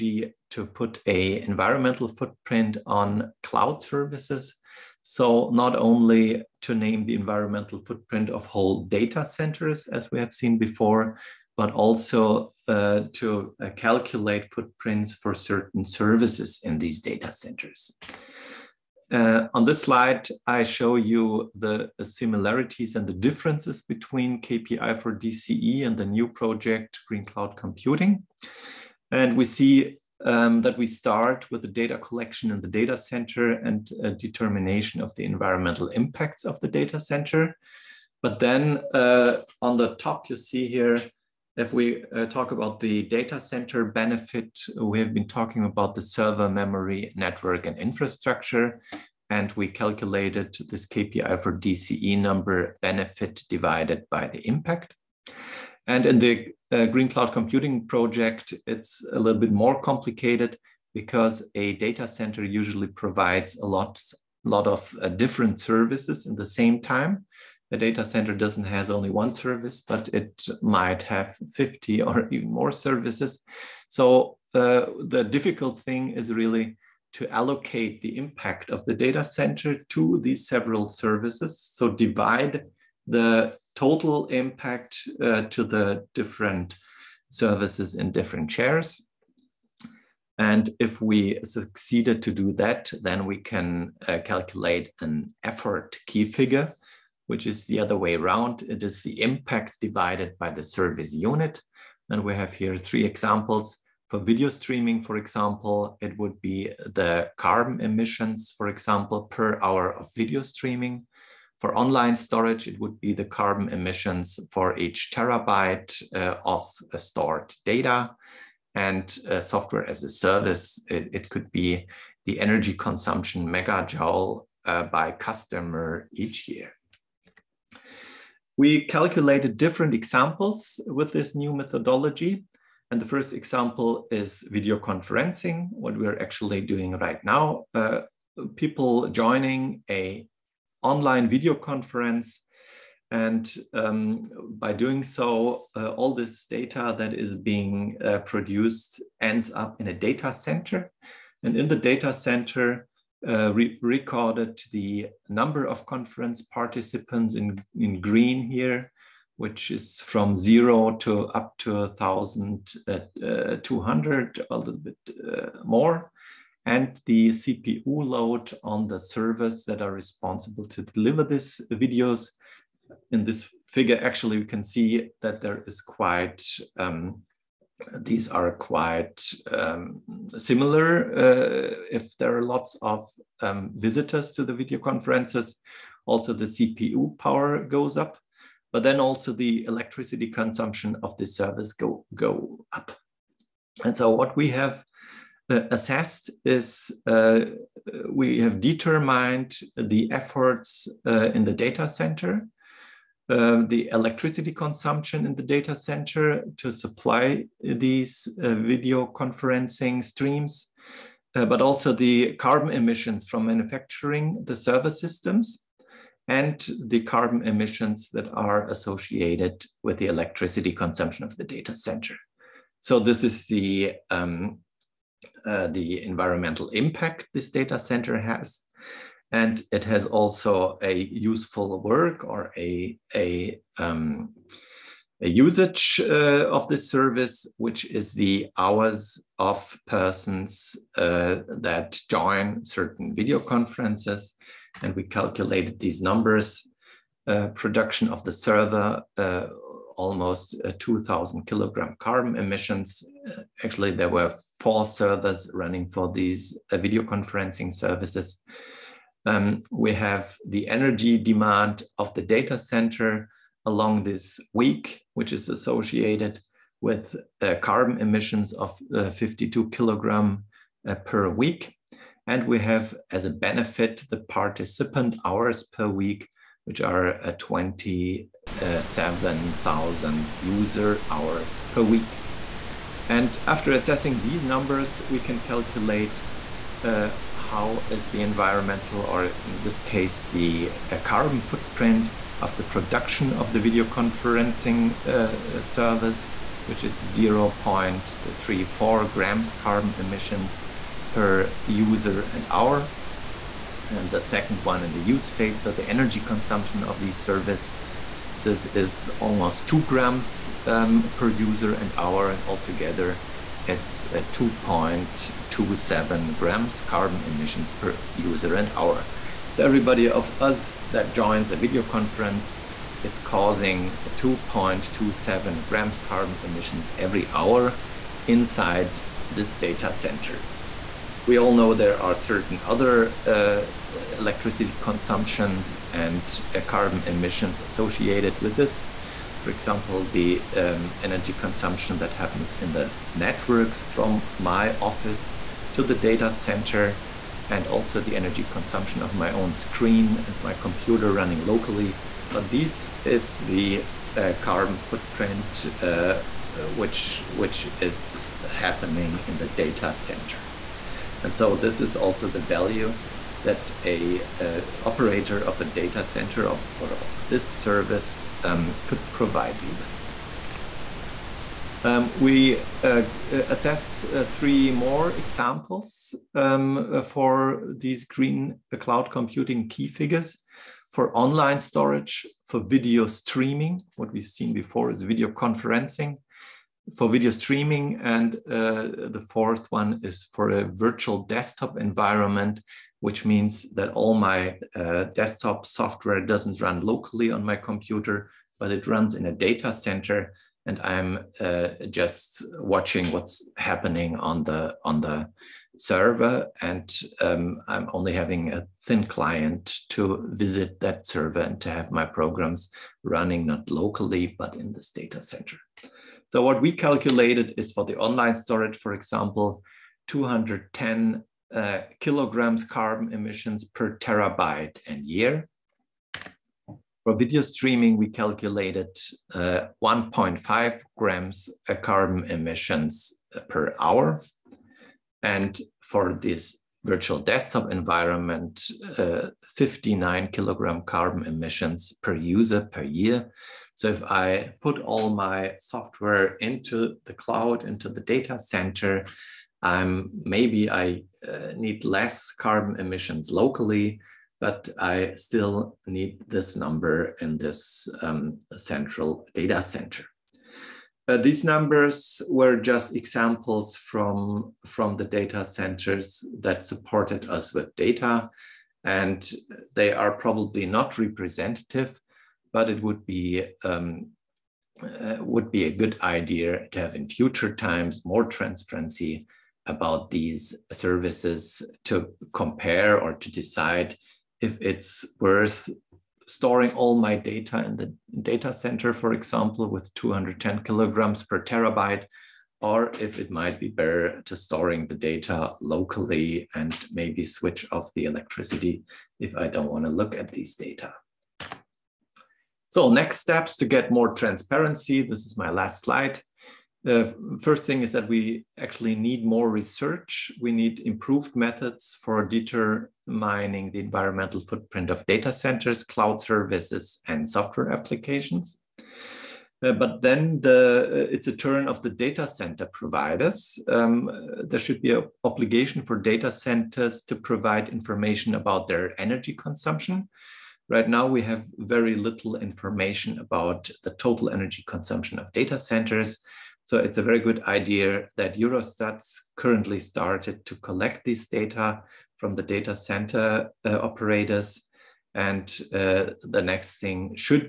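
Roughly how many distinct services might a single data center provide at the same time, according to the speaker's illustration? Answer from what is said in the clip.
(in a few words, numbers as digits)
50.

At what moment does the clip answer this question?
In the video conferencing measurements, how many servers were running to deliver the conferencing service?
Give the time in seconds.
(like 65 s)
254 s.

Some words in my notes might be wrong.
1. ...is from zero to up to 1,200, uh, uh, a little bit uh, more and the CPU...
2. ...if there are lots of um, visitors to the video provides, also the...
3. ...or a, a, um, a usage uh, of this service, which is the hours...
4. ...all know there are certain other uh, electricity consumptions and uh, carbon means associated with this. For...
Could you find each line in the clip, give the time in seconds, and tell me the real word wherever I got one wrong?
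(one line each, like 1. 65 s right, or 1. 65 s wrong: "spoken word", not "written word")
1. 159 s right
2. 181 s wrong: "conferences", not "provides"
3. 232 s right
4. 331 s wrong: "emissions", not "means".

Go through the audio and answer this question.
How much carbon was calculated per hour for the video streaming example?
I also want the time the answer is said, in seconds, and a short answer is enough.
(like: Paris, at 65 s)
1.5 grams, at 429 s.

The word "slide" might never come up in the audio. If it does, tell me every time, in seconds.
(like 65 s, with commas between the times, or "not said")
19 s, 505 s.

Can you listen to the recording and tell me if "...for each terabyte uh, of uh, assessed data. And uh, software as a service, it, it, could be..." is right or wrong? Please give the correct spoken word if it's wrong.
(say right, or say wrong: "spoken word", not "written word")
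wrong: "stored", not "assessed".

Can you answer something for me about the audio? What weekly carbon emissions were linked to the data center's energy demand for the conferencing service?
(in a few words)
52 kilograms.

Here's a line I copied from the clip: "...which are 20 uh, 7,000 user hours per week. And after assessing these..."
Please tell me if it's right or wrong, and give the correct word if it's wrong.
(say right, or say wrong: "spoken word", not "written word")
right.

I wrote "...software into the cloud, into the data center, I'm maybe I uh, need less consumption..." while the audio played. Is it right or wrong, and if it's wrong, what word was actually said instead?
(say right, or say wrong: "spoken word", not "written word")
wrong: "carbon", not "consumption".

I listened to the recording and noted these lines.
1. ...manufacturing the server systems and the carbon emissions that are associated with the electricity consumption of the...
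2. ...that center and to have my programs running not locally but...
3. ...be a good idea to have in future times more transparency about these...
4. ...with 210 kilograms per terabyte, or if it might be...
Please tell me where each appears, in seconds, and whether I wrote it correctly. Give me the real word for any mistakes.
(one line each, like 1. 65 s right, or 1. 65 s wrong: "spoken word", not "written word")
1. 213 s right
2. 410 s wrong: "server", not "center"
3. 475 s right
4. 489 s right.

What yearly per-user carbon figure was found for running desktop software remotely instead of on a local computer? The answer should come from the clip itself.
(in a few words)
59 kilograms.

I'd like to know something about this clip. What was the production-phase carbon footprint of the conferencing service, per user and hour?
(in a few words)
0.34 grams.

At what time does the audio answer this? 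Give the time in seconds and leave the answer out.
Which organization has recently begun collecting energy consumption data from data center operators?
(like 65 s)
538 s.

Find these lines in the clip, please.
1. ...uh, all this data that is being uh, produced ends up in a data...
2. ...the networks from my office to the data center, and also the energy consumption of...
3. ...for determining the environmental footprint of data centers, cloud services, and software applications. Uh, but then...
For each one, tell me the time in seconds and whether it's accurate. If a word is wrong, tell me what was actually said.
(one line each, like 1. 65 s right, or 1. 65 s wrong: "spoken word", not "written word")
1. 145 s right
2. 342 s right
3. 512 s right.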